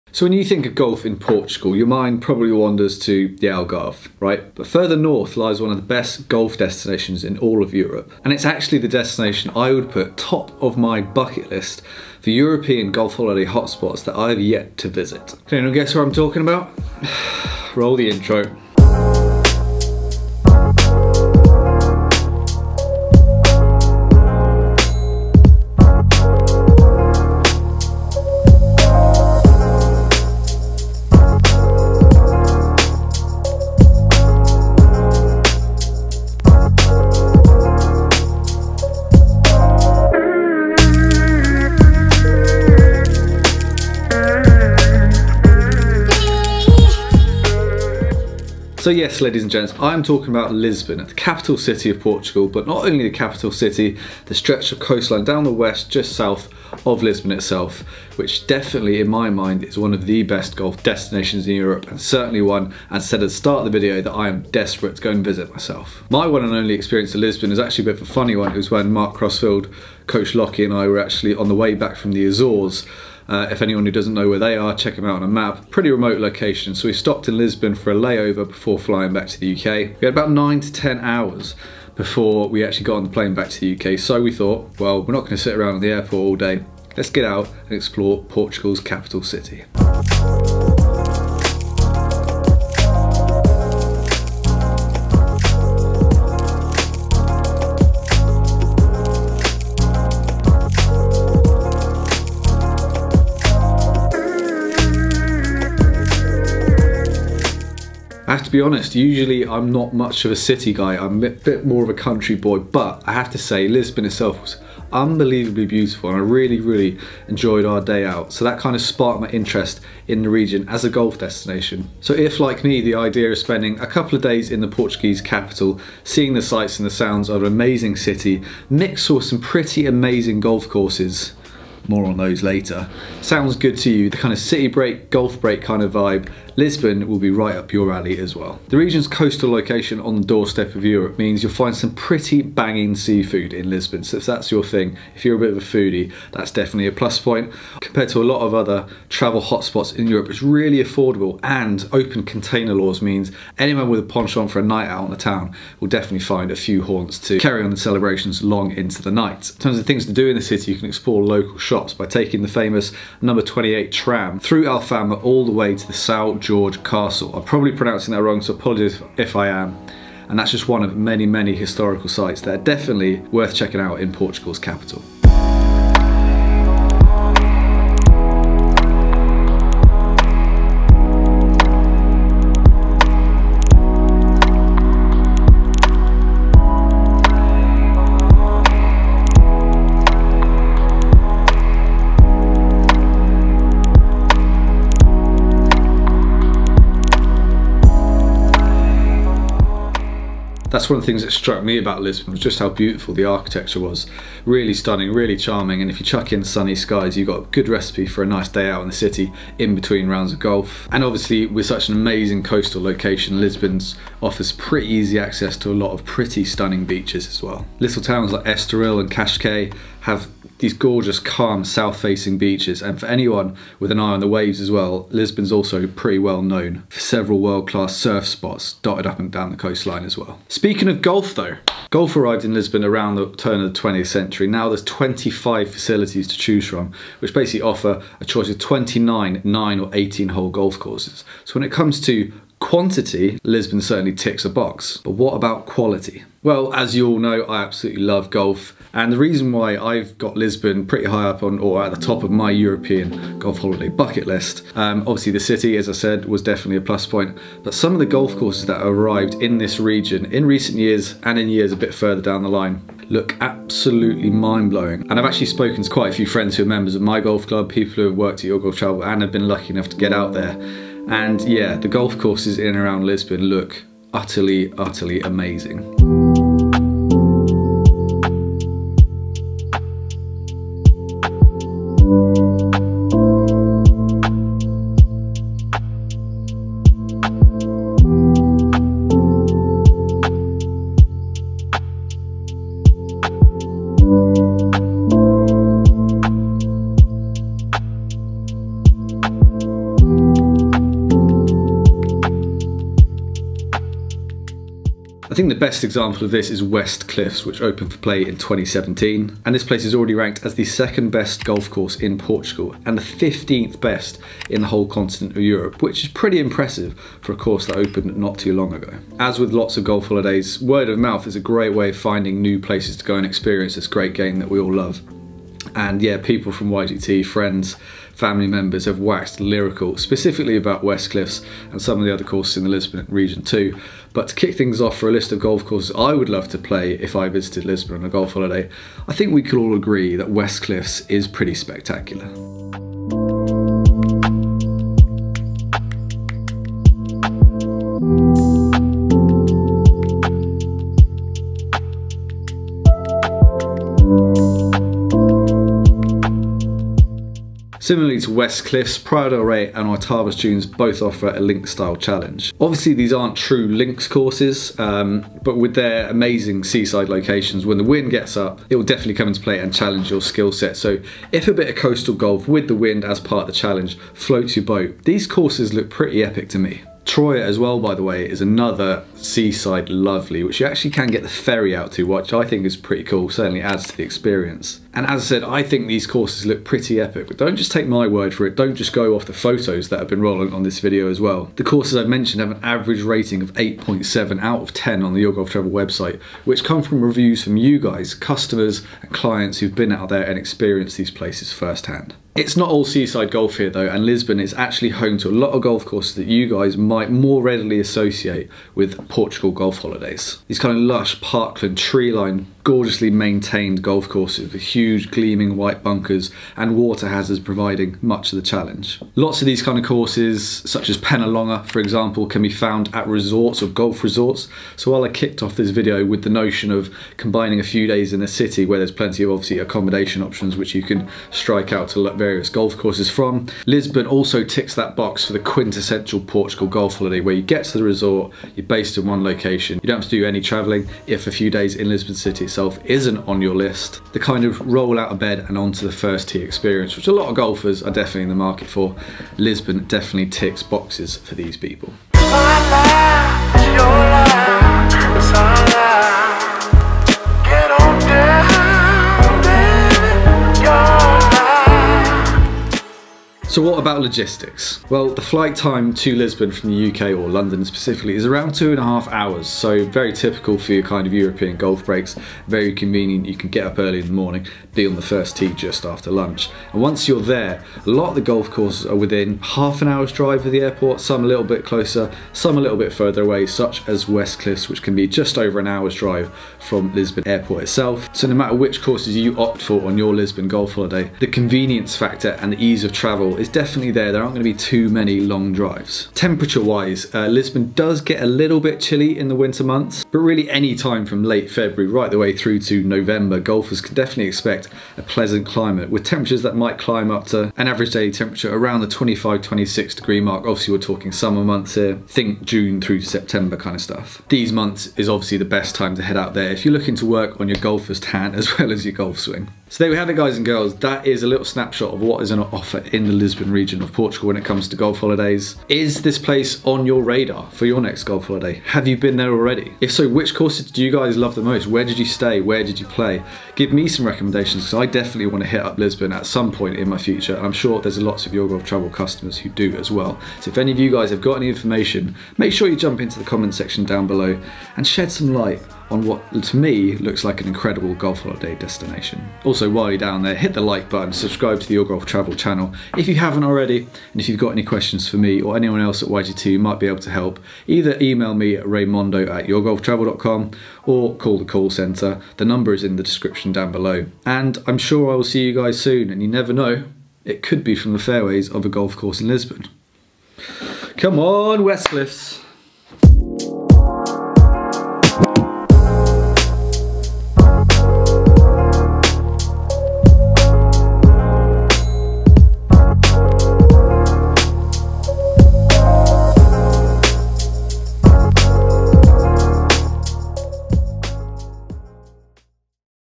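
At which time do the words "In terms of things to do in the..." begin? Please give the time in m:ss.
2:39.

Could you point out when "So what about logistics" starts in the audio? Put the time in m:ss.
7:43.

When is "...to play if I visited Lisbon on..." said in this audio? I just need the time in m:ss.
5:36.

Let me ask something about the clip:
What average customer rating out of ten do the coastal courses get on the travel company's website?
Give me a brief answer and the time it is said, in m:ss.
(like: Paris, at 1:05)
8.7, at 6:33.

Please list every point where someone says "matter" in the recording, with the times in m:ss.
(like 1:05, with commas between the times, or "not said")
8:08.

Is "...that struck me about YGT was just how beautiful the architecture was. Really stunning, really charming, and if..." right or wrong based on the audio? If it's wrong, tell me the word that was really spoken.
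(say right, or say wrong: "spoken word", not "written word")
wrong: "Lisbon", not "YGT".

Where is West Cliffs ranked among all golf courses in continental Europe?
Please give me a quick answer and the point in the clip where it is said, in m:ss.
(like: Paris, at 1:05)
15th, at 5:13.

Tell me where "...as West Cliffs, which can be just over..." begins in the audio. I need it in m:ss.
8:03.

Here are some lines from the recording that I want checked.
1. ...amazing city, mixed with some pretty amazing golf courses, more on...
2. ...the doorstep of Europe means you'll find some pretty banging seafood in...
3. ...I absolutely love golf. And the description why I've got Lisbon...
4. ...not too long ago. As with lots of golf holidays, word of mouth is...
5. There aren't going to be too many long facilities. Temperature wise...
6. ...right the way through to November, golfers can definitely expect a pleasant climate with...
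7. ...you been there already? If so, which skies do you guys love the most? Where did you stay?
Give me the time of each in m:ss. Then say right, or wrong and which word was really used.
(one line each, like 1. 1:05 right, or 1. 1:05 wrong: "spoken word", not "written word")
1. 2:07 right
2. 2:20 right
3. 4:07 wrong: "reason", not "description"
4. 5:18 right
5. 8:14 wrong: "drives", not "facilities"
6. 8:21 right
7. 8:48 wrong: "courses", not "skies".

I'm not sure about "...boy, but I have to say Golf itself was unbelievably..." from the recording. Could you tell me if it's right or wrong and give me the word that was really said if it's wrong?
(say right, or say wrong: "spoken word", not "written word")
wrong: "Lisbon", not "Golf".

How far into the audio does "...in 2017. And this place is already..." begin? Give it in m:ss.
5:08.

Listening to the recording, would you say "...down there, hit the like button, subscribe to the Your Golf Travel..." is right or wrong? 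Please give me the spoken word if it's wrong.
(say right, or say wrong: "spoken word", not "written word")
right.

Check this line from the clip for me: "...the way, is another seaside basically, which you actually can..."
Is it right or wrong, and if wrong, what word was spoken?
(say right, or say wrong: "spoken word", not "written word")
wrong: "lovely", not "basically".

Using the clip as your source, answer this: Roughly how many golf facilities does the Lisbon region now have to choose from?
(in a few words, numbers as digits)
25.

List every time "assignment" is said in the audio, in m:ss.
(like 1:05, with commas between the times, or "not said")
not said.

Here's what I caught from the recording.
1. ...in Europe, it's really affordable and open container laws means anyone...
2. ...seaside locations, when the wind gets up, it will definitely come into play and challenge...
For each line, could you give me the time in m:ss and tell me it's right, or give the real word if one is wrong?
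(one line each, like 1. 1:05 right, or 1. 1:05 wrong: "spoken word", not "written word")
1. 2:29 right
2. 6:06 right.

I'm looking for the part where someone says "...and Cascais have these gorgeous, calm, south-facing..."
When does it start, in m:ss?
3:39.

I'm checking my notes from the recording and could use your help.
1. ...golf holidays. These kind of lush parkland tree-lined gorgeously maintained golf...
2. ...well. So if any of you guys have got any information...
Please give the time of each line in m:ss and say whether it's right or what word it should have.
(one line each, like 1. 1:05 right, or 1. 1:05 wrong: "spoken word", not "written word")
1. 6:49 right
2. 8:59 right.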